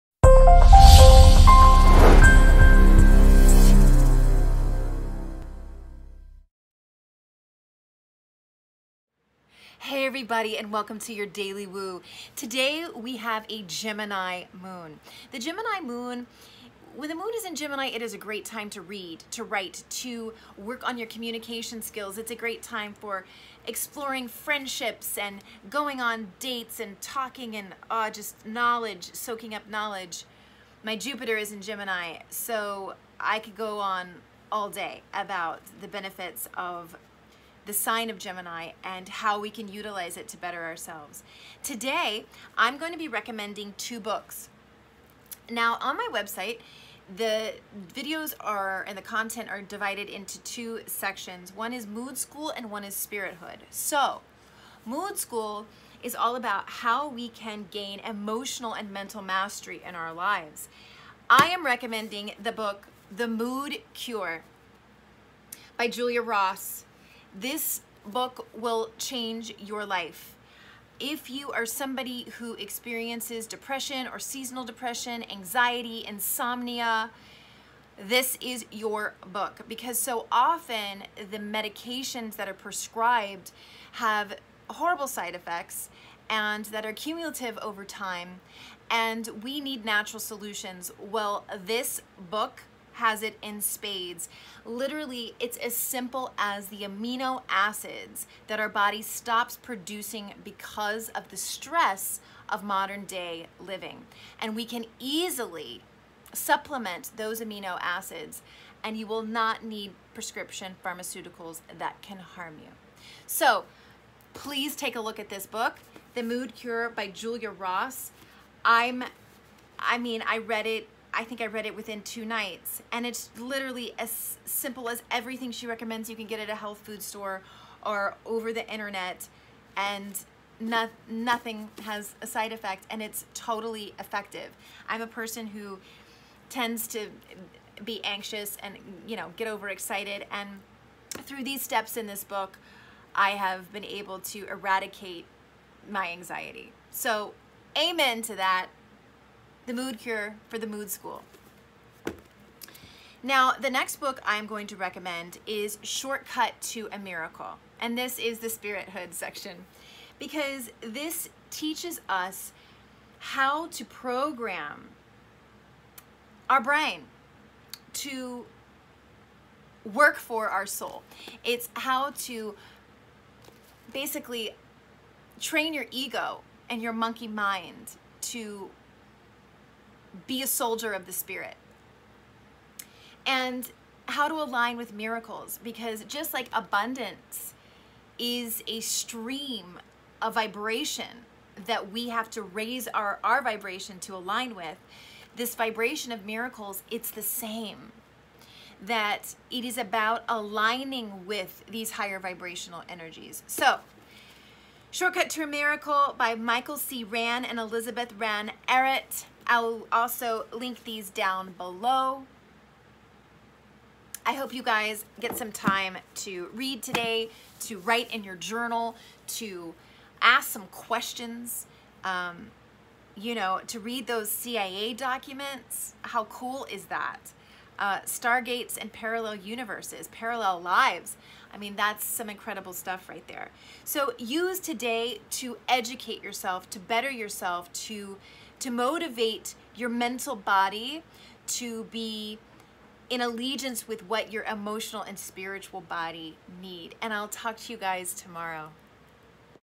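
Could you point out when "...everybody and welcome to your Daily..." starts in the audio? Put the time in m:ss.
0:10.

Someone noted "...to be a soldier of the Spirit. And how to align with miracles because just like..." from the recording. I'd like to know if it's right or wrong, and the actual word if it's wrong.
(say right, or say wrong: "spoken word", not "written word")
right.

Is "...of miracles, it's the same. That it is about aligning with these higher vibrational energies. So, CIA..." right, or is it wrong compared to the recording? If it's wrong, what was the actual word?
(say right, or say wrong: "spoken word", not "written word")
wrong: "Shortcut", not "CIA".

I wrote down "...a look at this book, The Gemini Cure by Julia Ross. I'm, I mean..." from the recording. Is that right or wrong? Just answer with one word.
wrong.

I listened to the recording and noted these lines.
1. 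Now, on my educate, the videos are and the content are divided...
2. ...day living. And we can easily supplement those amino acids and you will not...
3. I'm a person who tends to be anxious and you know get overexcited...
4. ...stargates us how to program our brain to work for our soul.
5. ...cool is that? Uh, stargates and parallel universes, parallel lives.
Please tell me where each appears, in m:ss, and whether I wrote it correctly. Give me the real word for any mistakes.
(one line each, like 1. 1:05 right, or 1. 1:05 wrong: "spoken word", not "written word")
1. 0:45 wrong: "website", not "educate"
2. 1:43 right
3. 2:14 right
4. 2:41 wrong: "teaches", not "stargates"
5. 3:46 right.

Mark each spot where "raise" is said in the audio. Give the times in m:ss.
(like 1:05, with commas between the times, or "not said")
3:12.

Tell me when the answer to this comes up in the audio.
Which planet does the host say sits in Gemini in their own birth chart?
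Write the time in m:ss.
0:30.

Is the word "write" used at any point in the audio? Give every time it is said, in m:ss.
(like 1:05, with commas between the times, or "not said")
0:19, 3:37.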